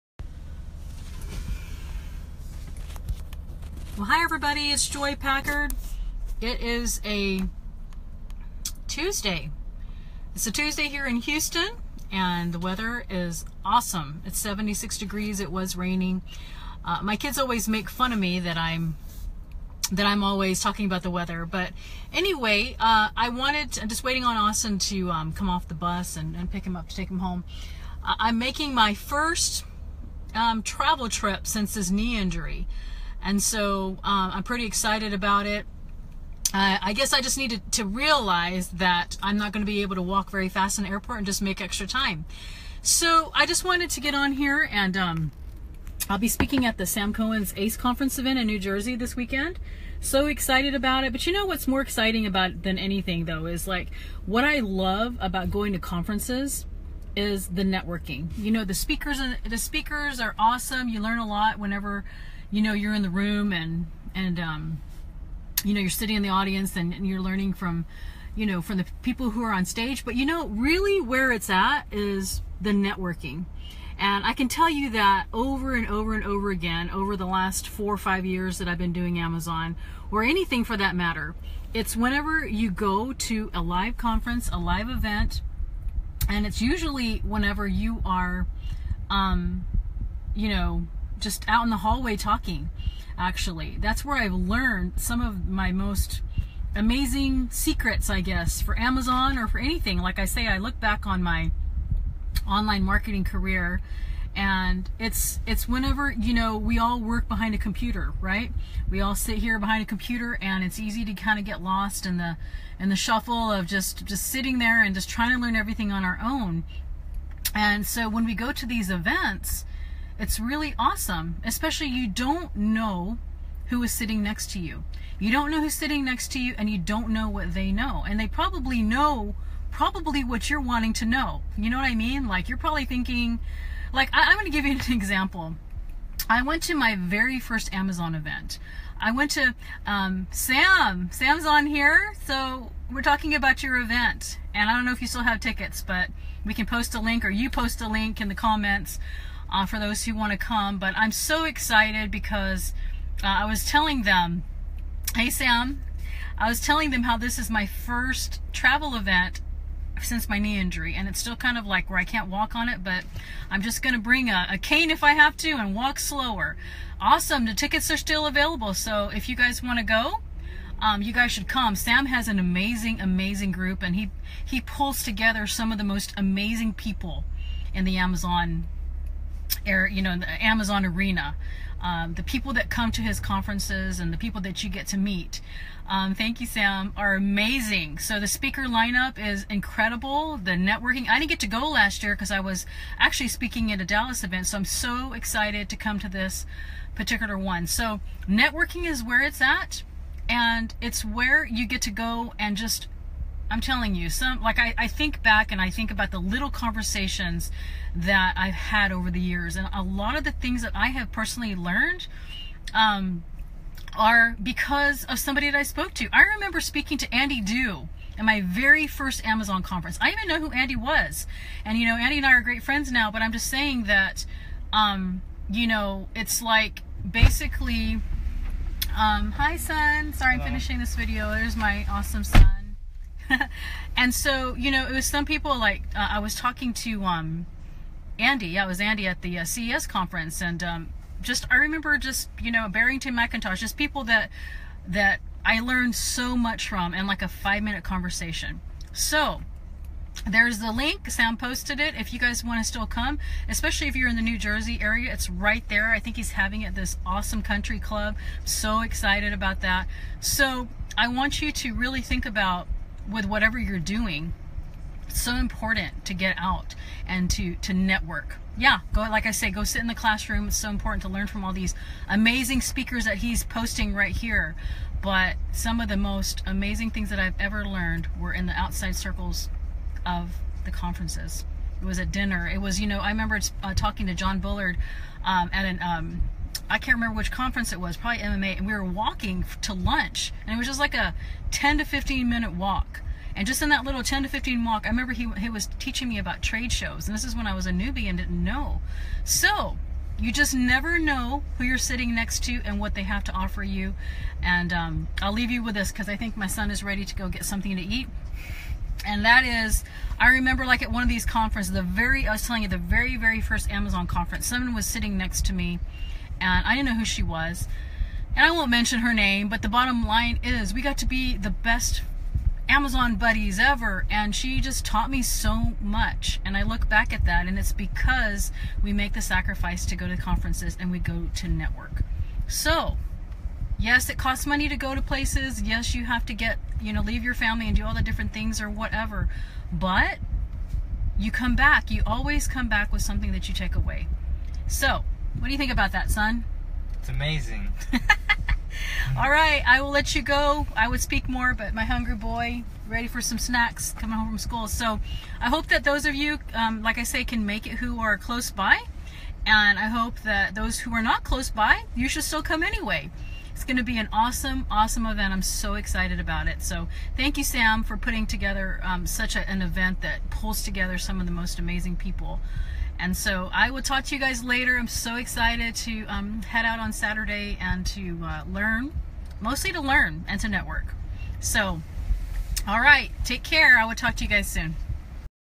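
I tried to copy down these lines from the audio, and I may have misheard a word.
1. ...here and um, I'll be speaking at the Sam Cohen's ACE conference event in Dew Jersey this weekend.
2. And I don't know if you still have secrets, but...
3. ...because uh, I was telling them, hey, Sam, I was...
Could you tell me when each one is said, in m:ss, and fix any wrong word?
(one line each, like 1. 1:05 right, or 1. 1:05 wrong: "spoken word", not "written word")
1. 0:44 wrong: "New", not "Dew"
2. 2:24 wrong: "tickets", not "secrets"
3. 2:32 right.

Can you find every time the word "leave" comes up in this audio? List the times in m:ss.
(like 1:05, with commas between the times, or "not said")
5:05, 5:37.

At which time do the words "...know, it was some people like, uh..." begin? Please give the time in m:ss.
3:54.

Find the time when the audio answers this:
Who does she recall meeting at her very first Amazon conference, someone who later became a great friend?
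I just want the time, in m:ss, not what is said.
3:37.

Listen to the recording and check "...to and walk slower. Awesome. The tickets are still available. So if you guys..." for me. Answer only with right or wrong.
right.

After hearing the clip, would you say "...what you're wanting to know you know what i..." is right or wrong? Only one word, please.
right.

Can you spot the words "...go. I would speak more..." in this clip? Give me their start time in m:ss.
5:50.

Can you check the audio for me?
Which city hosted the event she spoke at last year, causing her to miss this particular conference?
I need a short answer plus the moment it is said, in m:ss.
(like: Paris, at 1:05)
Dallas, at 3:13.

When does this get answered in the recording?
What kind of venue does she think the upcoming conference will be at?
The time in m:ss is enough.
4:17.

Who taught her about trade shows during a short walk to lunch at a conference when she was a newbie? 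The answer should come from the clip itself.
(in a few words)
John Bullard.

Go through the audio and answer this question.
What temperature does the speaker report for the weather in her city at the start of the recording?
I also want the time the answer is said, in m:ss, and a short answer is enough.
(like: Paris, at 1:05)
76 degrees, at 0:14.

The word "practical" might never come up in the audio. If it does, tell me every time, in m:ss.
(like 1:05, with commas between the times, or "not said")
not said.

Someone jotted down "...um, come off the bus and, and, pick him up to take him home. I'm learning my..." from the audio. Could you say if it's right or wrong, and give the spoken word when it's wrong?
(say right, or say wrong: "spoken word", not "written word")
wrong: "making", not "learning".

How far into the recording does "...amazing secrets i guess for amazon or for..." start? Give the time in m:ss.
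1:36.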